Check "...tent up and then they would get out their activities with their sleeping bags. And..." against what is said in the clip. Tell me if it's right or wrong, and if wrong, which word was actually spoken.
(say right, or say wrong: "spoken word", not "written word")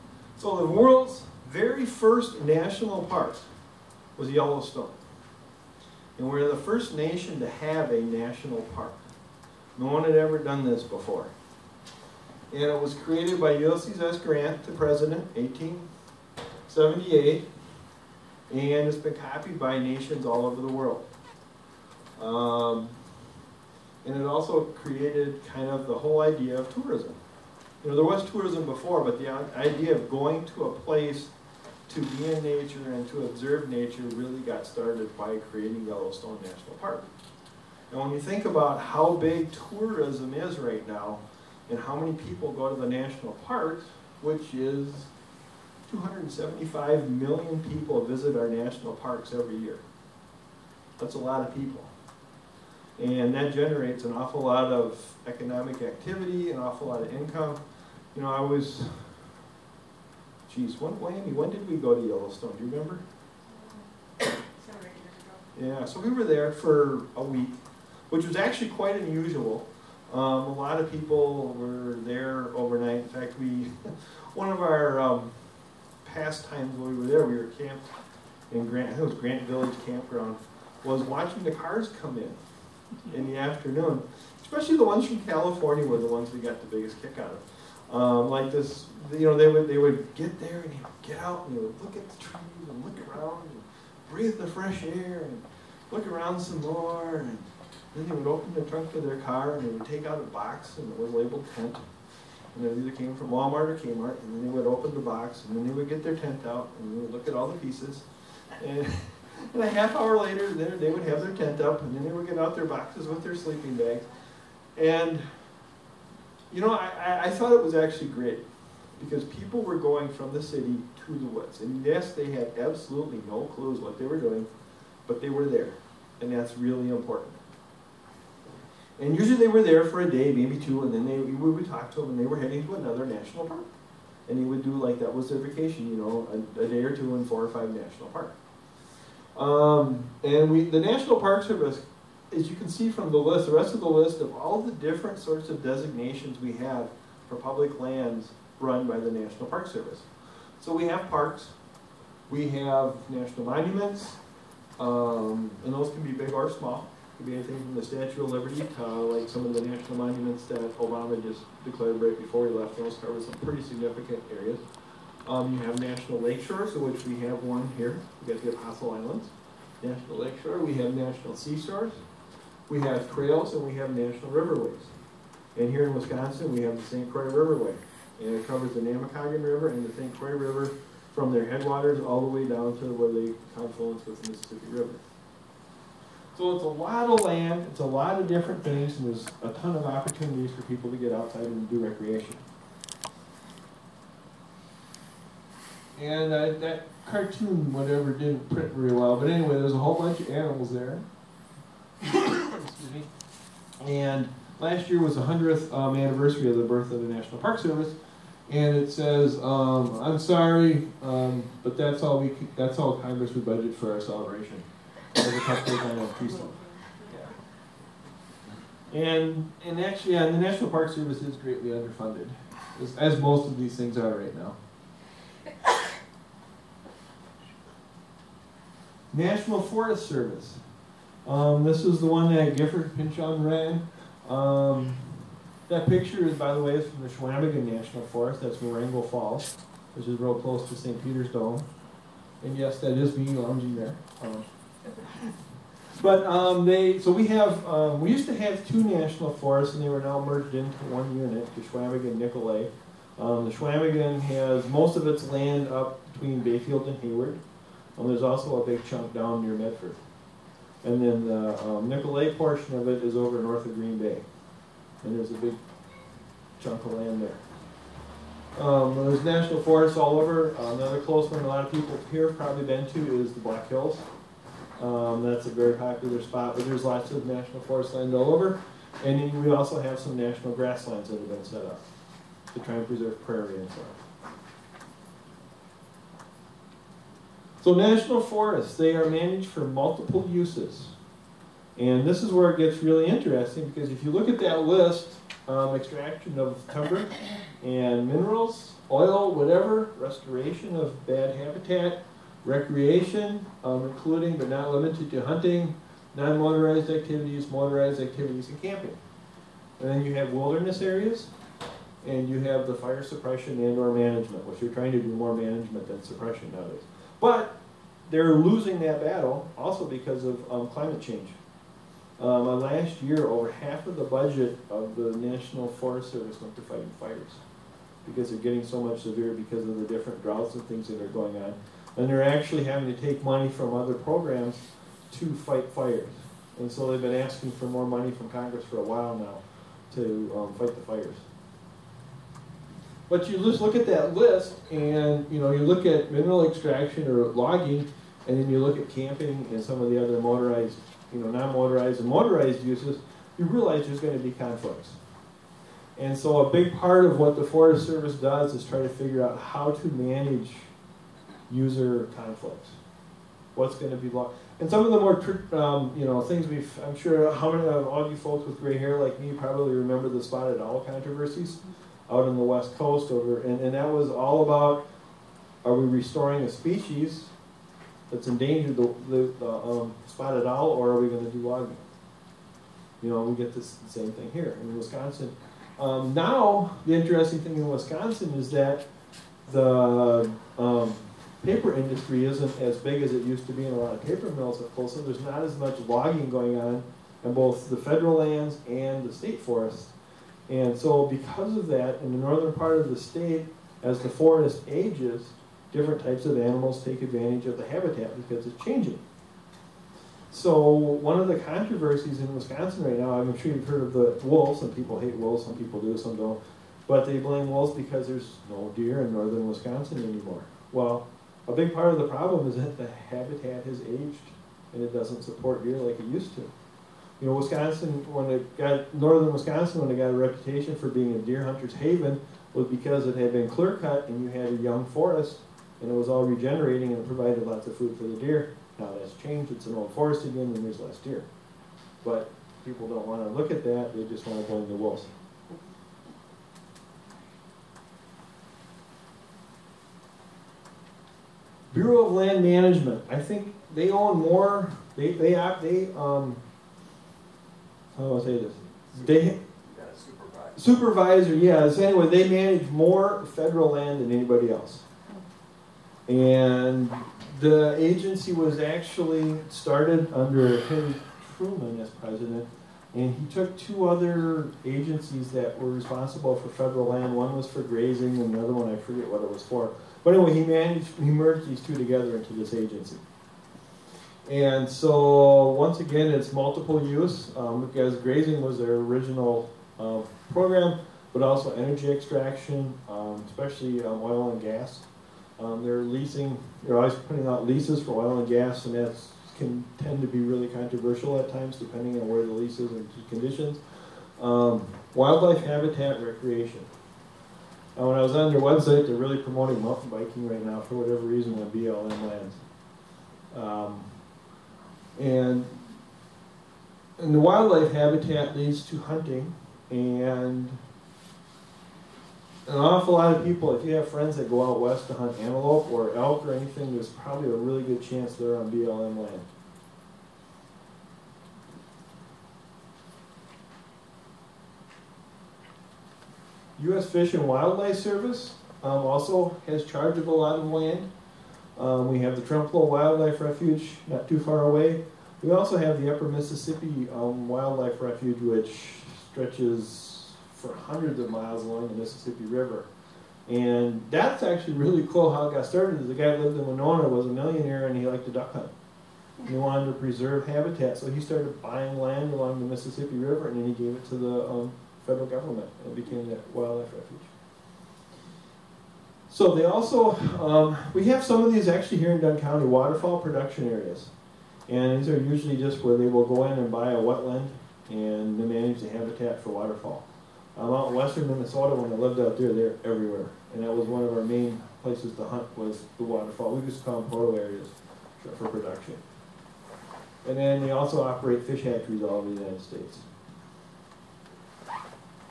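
wrong: "boxes", not "activities".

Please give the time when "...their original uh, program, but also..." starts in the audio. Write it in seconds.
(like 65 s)
488 s.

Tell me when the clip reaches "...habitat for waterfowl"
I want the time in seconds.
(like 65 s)
578 s.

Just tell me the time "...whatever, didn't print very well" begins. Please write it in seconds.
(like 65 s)
197 s.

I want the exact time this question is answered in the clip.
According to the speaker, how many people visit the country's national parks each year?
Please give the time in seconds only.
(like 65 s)
45 s.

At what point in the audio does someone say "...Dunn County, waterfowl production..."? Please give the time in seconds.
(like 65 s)
571 s.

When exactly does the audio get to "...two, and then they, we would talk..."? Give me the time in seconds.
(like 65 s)
130 s.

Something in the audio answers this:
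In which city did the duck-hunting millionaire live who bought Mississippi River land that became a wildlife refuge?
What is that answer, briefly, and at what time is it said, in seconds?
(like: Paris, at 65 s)
Winona, at 556 s.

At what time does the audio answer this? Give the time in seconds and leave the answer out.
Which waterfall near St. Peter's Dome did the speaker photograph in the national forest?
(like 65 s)
238 s.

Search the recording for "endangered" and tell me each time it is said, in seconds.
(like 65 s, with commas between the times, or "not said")
378 s.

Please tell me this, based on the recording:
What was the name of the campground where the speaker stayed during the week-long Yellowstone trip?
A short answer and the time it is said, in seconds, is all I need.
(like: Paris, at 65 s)
Grant Village Campground, at 79 s.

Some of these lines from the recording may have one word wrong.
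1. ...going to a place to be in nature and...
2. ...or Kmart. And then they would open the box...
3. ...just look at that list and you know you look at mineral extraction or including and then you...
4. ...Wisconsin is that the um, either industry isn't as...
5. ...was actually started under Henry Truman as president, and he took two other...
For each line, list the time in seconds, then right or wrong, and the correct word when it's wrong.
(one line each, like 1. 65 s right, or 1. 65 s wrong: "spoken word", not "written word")
1. 30 s right
2. 103 s right
3. 343 s wrong: "logging", not "including"
4. 387 s wrong: "paper", not "either"
5. 468 s right.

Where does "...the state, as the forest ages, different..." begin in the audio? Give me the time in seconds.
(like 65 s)
402 s.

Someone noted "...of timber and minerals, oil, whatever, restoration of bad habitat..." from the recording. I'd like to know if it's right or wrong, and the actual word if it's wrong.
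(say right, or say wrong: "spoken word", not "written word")
right.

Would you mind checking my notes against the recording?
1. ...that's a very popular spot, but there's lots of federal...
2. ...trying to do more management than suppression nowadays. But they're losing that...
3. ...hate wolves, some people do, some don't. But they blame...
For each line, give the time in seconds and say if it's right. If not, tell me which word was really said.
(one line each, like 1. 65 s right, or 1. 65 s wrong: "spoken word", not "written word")
1. 275 s wrong: "national", not "federal"
2. 314 s right
3. 414 s right.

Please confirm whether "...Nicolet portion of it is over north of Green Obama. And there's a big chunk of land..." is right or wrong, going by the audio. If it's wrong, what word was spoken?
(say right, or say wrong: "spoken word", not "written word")
wrong: "Bay", not "Obama".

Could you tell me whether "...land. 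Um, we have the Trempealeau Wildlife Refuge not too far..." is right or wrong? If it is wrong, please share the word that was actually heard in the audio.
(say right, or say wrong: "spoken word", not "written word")
right.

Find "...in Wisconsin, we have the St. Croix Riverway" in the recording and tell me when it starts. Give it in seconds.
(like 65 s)
175 s.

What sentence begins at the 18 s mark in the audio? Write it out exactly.
And it's been copied by nations all over the world.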